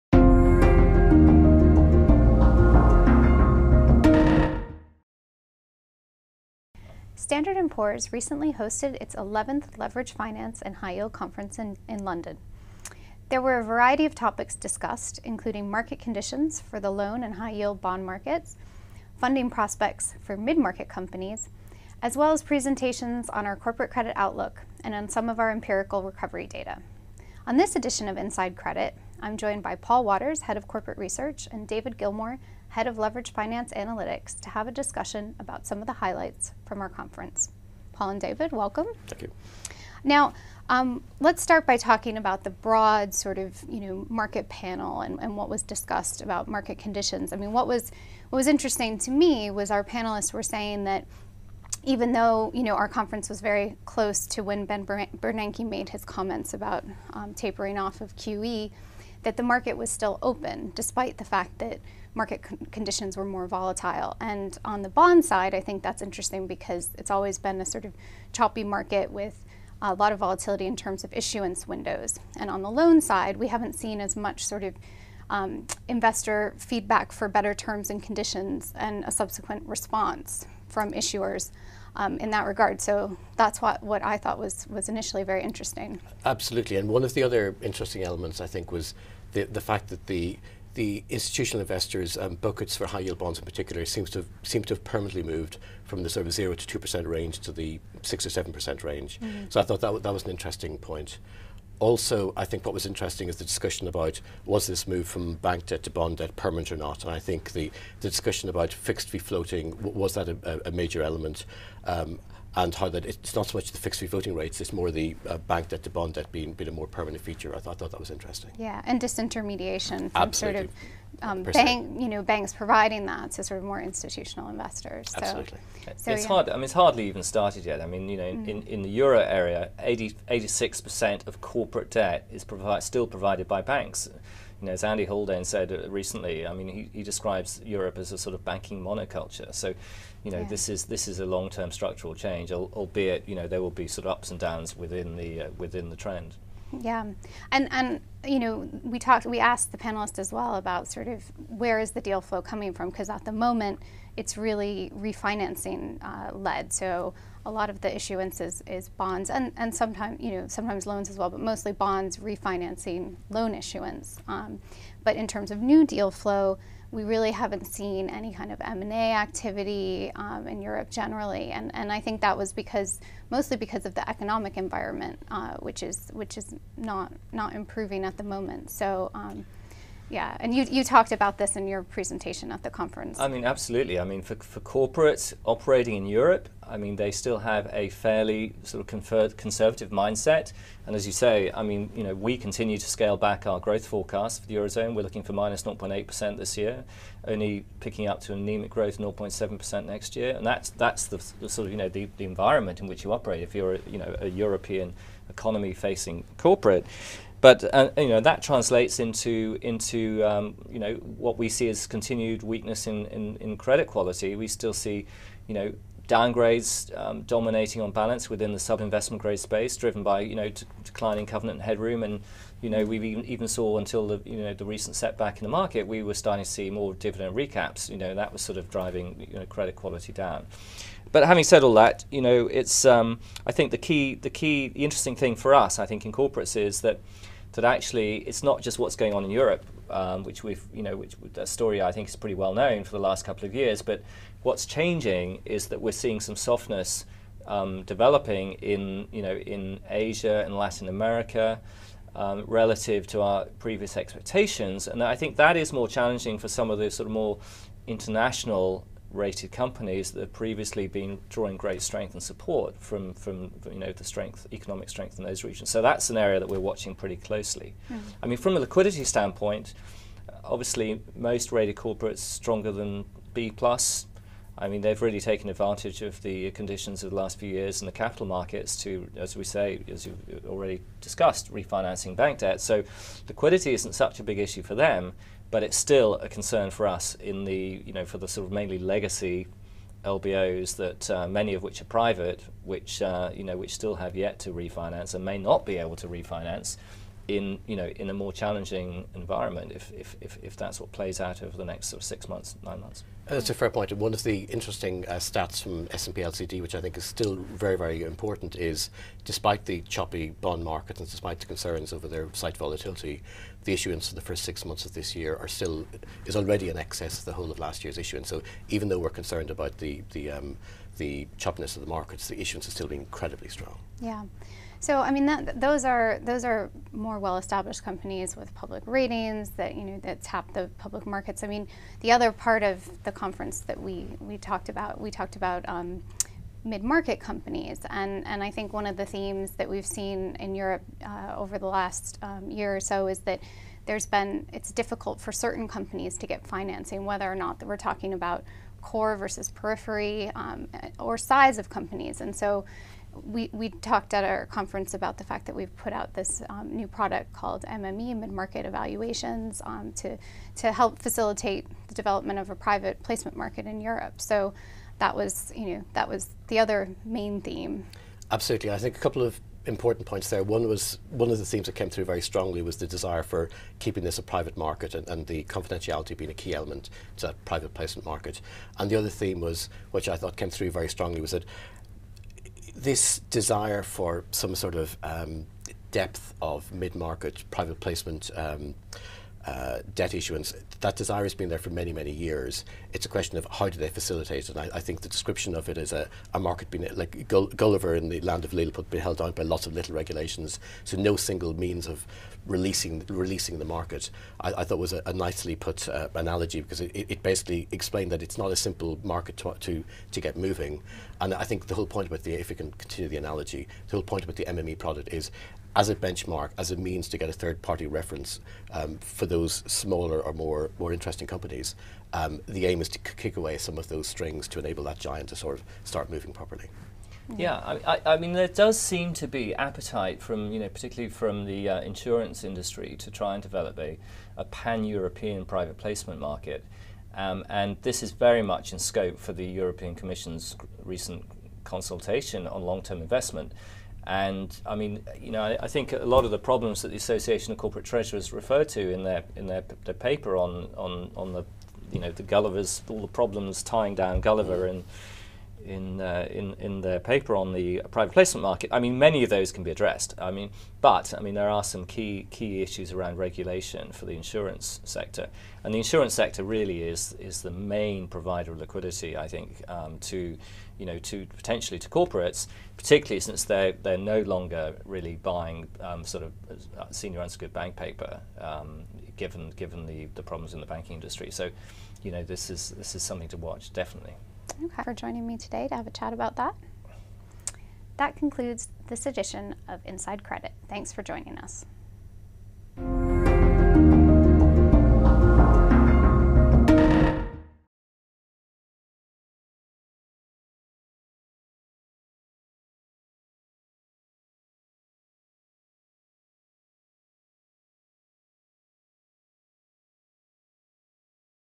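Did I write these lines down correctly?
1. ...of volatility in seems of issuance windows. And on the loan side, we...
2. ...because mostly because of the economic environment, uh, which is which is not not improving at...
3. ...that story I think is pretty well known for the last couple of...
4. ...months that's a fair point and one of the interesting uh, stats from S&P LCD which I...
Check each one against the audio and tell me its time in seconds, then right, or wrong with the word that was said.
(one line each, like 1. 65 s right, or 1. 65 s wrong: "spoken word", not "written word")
1. 70 s wrong: "terms", not "seems"
2. 172 s right
3. 241 s right
4. 302 s right.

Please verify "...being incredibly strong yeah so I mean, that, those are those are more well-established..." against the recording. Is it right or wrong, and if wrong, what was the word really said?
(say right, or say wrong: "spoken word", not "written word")
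right.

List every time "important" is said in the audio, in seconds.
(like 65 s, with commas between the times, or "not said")
308 s, 369 s.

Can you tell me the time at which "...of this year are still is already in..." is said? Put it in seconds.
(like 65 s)
314 s.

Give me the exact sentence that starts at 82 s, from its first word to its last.
So that's what, what I thought was, was initially very interesting.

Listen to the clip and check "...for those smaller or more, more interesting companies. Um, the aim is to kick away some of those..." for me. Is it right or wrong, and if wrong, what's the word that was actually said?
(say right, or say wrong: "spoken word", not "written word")
right.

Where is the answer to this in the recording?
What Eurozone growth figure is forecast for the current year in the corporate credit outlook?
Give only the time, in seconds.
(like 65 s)
195 s.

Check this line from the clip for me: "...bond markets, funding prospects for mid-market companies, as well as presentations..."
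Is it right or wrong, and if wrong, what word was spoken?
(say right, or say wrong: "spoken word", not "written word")
right.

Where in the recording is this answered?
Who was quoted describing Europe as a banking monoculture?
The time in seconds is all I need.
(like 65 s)
134 s.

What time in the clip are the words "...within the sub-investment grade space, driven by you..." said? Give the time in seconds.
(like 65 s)
218 s.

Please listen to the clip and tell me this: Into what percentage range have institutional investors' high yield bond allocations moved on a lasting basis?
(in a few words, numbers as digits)
6 or 7 percent.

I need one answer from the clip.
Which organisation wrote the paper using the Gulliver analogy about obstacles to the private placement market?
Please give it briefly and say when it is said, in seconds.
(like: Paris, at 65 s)
Association of Corporate Treasurers, at 446 s.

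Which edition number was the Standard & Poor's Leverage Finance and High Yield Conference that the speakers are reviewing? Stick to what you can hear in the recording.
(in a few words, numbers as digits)
11th.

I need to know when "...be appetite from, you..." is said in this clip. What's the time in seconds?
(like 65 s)
429 s.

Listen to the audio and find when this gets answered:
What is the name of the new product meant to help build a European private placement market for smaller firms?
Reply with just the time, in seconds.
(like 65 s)
358 s.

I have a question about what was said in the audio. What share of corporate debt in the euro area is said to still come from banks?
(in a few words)
86 percent.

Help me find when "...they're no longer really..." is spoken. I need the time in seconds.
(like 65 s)
473 s.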